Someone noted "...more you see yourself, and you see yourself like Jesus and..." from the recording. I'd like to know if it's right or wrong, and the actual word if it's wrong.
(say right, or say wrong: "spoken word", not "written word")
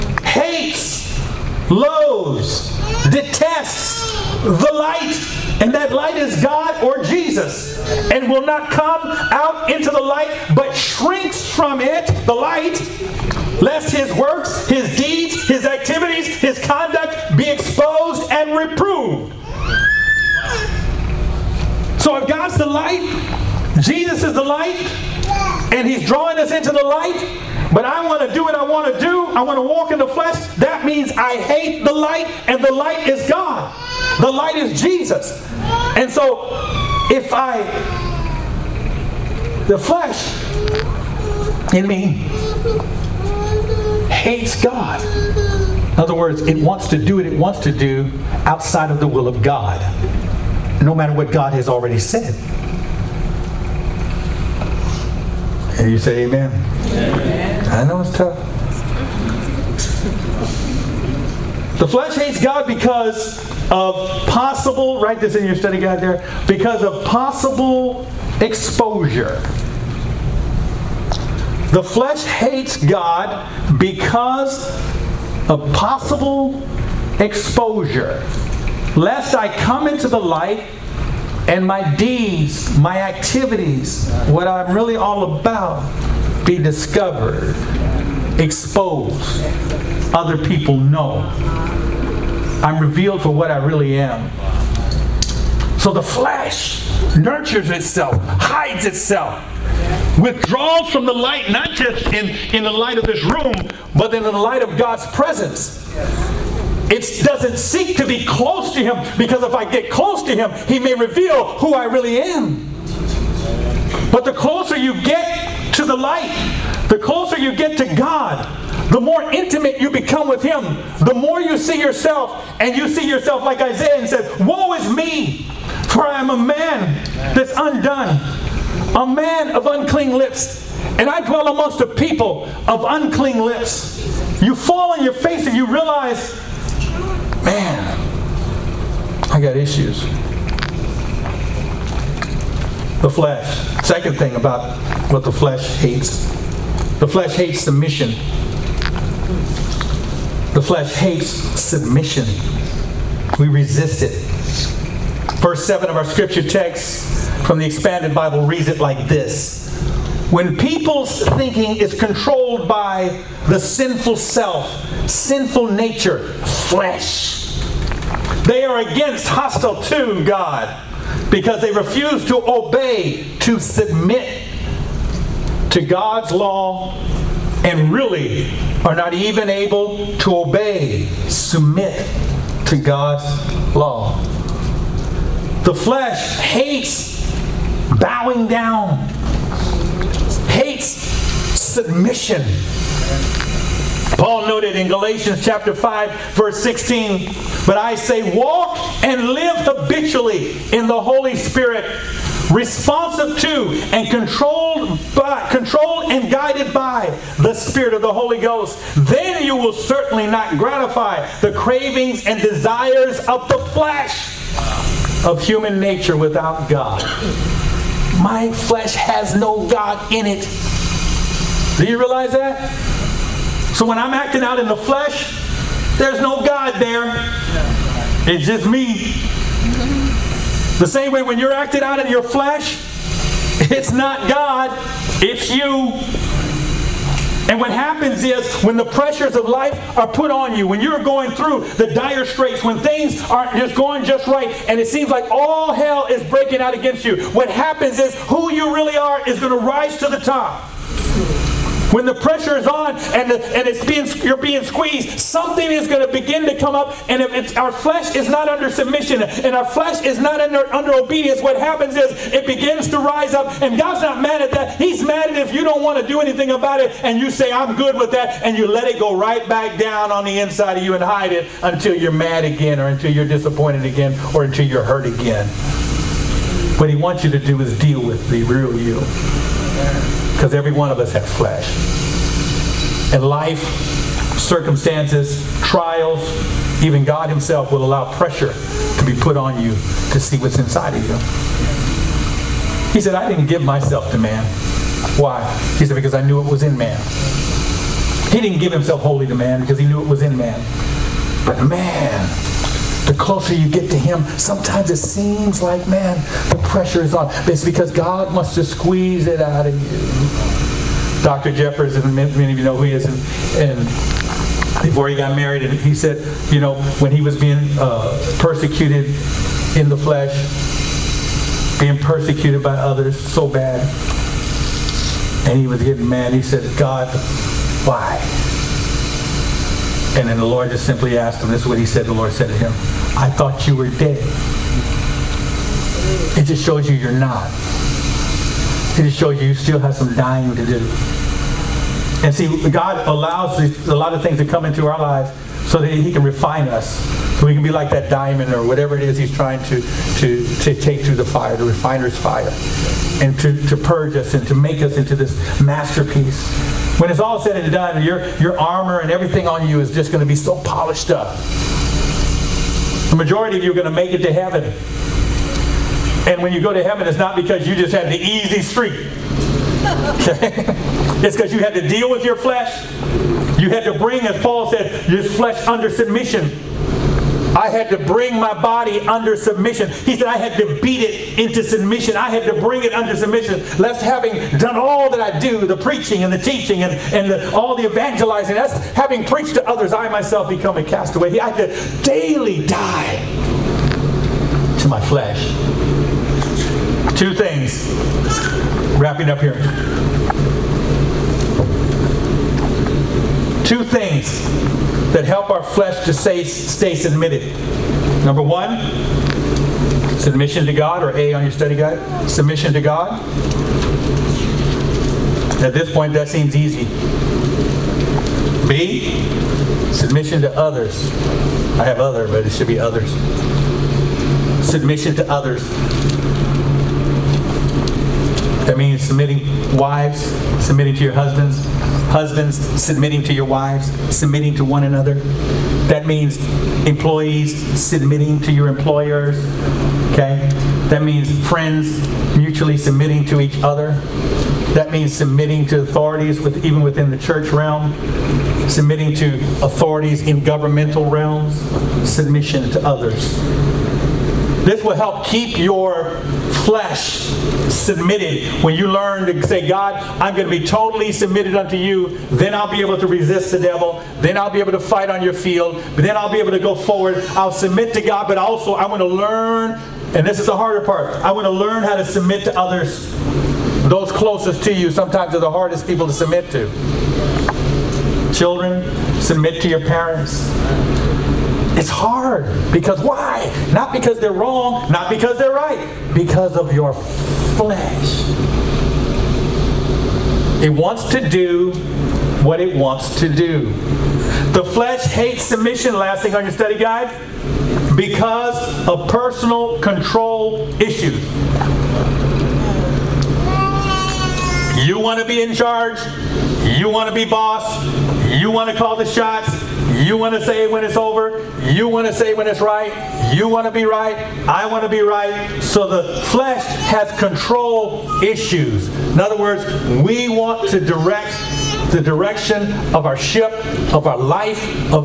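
wrong: "Isaiah", not "Jesus".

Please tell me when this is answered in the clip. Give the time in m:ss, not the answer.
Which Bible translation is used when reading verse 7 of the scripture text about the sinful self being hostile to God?
2:37.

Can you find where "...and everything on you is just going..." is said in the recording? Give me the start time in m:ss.
5:58.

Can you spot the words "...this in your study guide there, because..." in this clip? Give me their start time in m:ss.
1:05.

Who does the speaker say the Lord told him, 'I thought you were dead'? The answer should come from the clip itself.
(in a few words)
Dr. Jeffers.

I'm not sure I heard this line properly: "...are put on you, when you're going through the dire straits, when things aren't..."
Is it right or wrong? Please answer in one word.
right.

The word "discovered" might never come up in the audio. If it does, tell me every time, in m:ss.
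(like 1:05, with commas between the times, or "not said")
1:26.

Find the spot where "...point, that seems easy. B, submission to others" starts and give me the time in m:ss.
6:55.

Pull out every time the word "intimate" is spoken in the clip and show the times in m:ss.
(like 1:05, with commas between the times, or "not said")
1:59.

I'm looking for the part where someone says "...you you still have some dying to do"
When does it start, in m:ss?
5:39.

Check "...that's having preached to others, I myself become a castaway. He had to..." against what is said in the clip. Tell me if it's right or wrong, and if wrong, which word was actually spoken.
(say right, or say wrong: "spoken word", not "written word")
right.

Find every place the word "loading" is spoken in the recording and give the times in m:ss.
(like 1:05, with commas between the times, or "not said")
not said.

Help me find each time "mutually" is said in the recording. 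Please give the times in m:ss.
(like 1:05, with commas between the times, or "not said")
7:22.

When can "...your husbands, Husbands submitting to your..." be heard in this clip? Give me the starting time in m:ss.
7:11.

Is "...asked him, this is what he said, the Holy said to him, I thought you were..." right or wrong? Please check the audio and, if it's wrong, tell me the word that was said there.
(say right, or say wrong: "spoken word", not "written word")
wrong: "Lord", not "Holy".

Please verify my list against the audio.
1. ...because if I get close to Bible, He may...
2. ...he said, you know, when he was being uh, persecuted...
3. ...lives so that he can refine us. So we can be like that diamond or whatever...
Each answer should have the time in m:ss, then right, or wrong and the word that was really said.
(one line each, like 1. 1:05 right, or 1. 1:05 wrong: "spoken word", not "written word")
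1. 1:49 wrong: "Him", not "Bible"
2. 5:15 right
3. 5:45 right.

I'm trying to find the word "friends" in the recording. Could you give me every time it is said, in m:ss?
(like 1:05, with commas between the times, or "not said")
7:21.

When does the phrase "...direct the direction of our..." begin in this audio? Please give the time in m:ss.
8:40.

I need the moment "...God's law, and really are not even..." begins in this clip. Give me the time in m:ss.
2:55.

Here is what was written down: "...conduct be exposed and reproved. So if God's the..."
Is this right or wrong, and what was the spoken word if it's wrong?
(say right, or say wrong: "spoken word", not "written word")
right.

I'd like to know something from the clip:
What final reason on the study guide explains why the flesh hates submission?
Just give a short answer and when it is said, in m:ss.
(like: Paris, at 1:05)
Personal control issues, at 8:19.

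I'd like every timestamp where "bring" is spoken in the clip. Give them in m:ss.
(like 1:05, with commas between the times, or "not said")
6:13, 6:17, 6:22.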